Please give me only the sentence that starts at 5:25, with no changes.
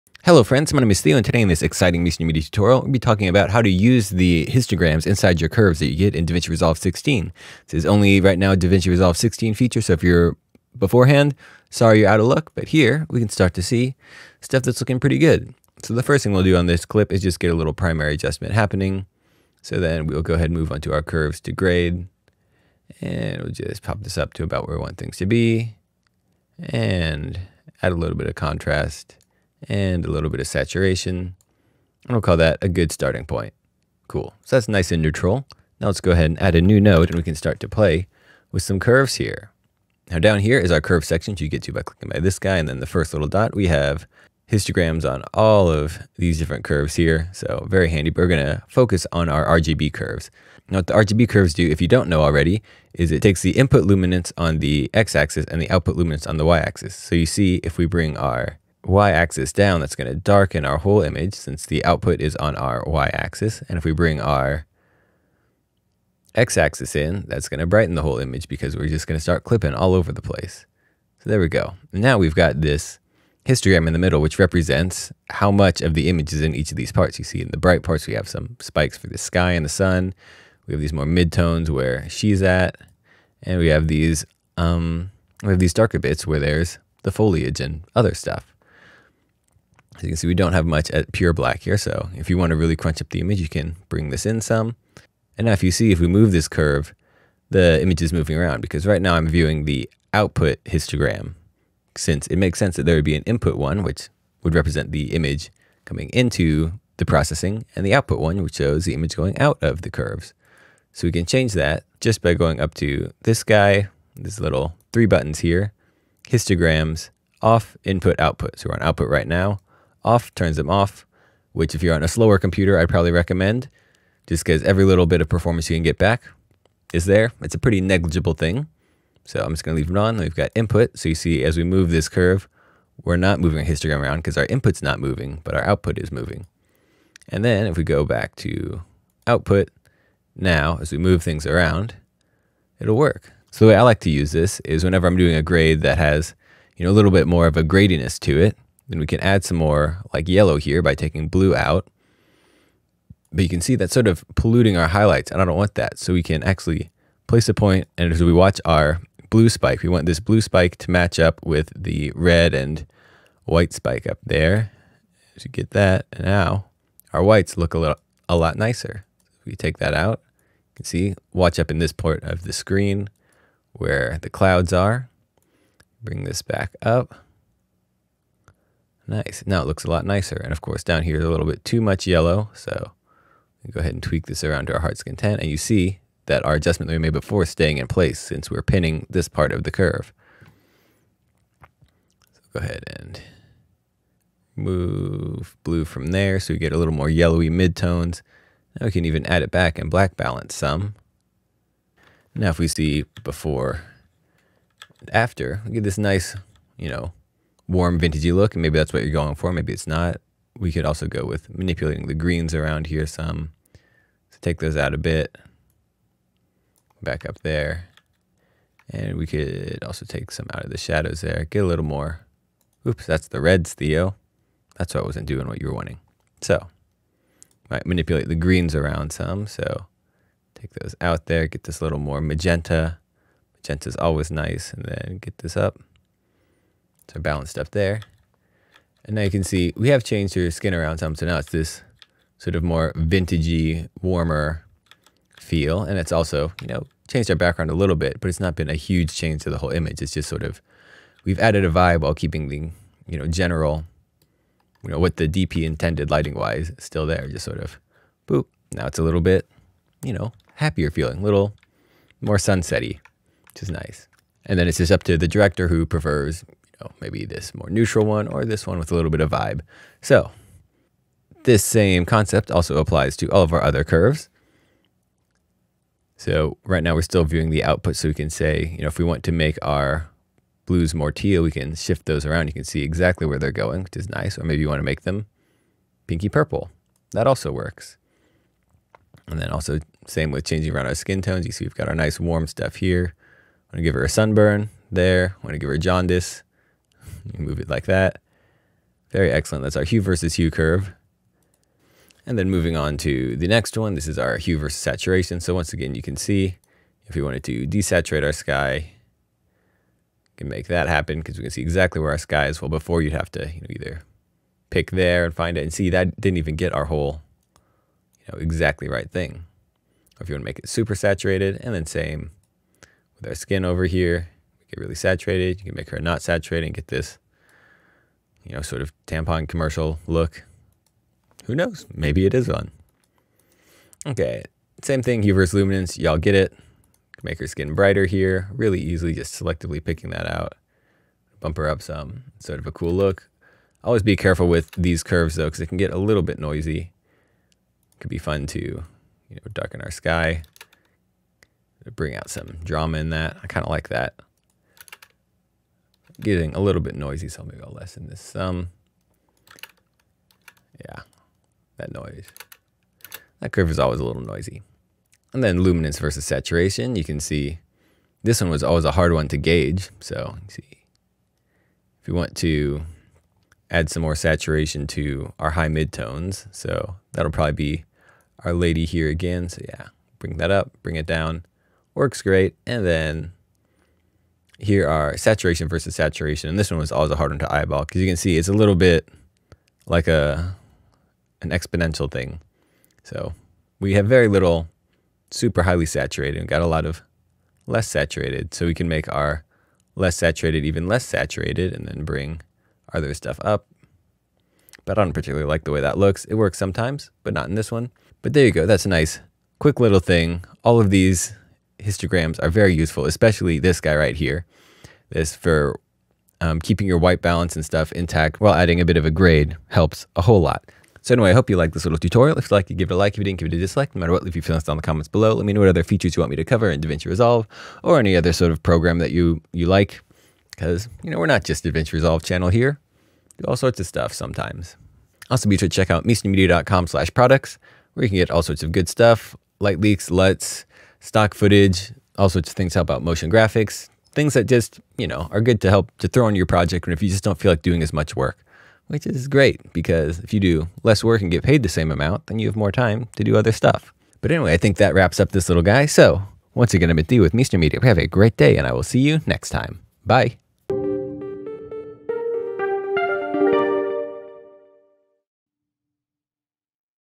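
You can make her not saturated and get this, you know, sort of tampon commercial look.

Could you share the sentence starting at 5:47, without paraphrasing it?
Could be fun to, you know, darken our sky.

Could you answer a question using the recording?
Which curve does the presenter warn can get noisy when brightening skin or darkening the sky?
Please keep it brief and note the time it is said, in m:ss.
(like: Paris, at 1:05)
Hue versus Luminance, at 5:35.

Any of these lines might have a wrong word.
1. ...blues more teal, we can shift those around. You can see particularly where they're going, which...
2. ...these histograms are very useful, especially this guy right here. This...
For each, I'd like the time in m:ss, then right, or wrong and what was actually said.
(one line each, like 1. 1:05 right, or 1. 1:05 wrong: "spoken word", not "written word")
1. 4:40 wrong: "exactly", not "particularly"
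2. 6:50 right.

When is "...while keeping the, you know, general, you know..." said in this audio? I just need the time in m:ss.
4:12.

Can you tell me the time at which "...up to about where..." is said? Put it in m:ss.
0:24.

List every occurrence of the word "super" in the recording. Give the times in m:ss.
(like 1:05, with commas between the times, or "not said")
5:20, 6:35.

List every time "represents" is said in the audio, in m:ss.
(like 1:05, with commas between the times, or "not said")
1:14, 1:44.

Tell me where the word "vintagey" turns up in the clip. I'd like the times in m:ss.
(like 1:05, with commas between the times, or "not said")
3:27, 4:02.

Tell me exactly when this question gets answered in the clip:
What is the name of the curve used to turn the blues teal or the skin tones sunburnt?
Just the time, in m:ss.
4:59.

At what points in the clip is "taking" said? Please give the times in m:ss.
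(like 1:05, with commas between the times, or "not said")
2:30.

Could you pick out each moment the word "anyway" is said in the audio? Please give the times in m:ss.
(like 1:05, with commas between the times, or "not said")
7:01, 7:34.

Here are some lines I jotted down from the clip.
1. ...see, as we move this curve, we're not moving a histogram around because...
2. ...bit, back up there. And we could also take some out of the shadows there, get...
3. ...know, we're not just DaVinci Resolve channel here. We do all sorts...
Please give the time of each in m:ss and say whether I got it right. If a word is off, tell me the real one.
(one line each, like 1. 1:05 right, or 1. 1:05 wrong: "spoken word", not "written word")
1. 2:11 right
2. 3:34 right
3. 7:11 right.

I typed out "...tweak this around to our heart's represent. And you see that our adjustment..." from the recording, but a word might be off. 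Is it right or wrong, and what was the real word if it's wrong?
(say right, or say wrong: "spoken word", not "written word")
wrong: "content", not "represent".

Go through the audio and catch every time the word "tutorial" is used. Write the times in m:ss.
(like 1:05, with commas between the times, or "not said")
0:02, 7:01.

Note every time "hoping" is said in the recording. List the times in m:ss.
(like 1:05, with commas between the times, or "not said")
not said.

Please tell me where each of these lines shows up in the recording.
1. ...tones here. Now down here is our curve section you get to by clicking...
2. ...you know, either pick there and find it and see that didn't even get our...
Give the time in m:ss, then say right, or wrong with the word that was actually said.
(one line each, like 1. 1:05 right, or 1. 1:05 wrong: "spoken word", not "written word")
1. 0:38 wrong: "curves", not "tones"
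2. 5:13 right.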